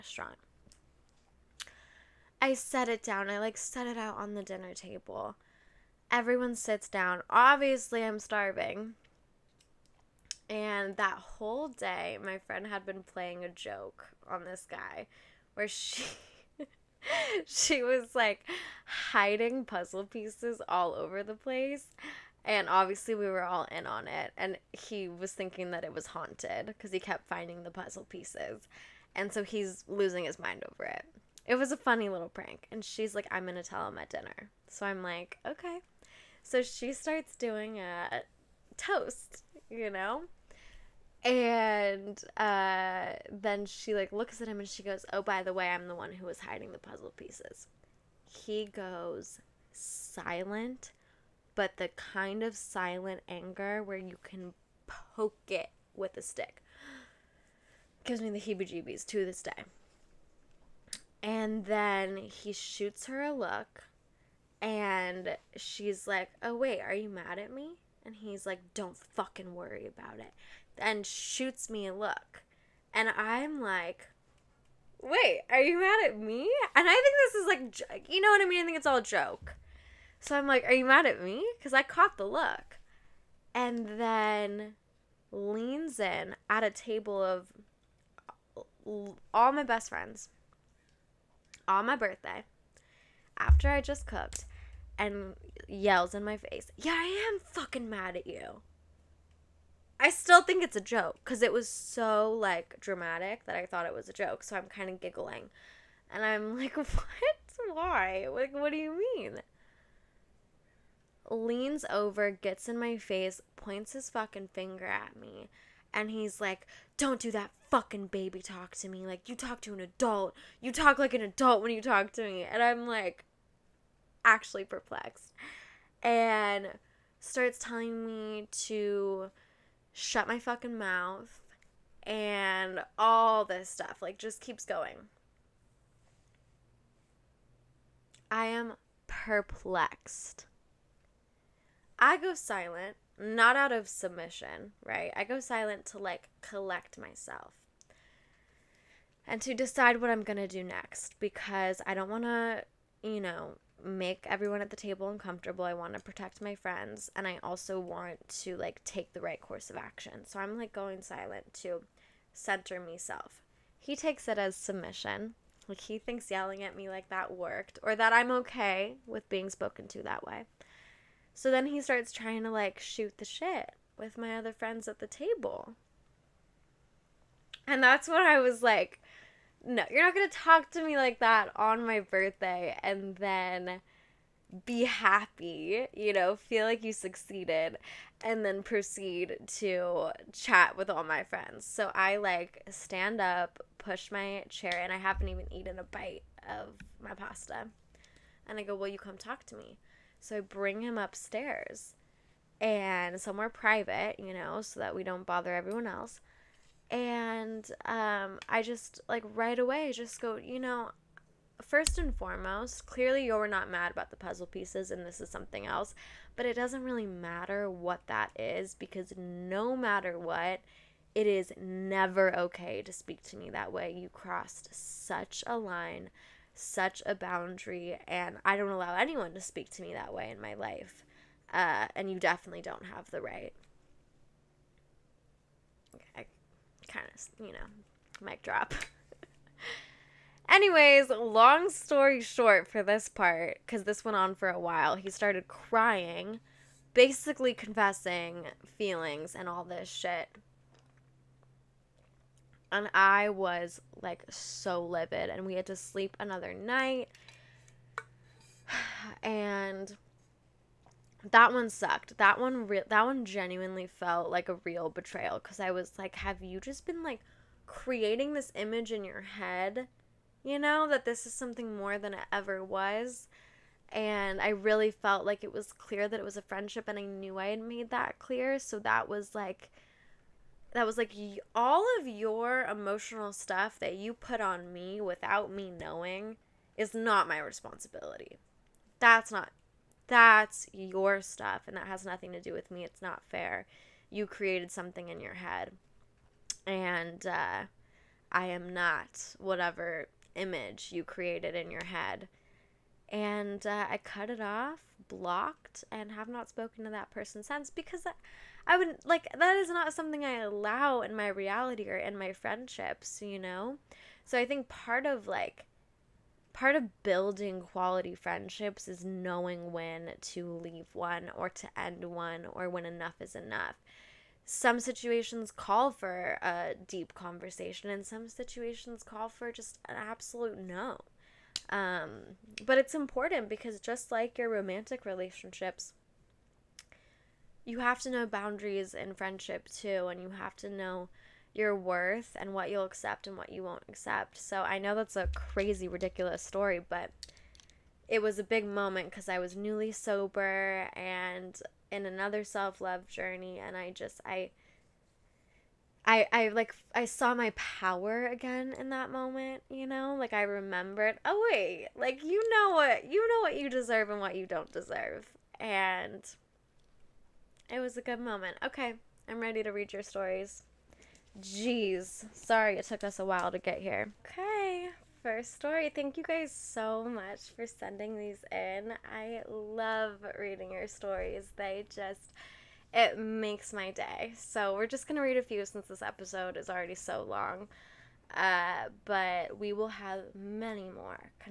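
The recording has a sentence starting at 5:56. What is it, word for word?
I, I like I saw my power again in that moment, you know?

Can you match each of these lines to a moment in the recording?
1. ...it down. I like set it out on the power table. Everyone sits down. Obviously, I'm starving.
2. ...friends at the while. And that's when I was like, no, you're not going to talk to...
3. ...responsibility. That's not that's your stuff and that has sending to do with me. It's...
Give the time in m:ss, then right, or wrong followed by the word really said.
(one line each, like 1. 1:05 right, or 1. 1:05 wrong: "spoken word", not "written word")
1. 0:02 wrong: "dinner", not "power"
2. 2:54 wrong: "table", not "while"
3. 4:47 wrong: "nothing", not "sending".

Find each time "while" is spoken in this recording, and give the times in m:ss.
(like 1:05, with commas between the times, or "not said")
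4:04, 6:13.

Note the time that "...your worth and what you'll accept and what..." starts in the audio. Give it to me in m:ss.
5:41.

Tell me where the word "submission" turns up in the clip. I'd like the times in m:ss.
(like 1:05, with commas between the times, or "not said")
2:23, 2:44.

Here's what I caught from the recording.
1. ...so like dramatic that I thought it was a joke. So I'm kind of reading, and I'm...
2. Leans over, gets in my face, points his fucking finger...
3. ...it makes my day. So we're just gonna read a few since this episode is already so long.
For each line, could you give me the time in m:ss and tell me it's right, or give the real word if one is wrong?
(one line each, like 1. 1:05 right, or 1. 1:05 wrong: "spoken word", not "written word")
1. 1:41 wrong: "giggling", not "reading"
2. 1:51 right
3. 6:22 right.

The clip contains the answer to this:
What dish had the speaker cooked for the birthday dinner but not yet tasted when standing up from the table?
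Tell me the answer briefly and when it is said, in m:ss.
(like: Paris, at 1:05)
pasta, at 3:17.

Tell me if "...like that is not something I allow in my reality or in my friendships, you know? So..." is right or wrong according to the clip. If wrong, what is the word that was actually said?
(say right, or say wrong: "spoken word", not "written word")
right.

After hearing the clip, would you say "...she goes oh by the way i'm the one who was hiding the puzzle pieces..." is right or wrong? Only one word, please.
right.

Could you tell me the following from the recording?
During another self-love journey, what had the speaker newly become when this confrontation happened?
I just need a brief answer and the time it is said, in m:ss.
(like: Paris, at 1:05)
sober, at 5:49.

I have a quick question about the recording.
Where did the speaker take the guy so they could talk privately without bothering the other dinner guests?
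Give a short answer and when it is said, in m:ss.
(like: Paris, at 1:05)
upstairs, at 3:20.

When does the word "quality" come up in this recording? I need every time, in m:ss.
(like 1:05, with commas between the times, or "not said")
5:17.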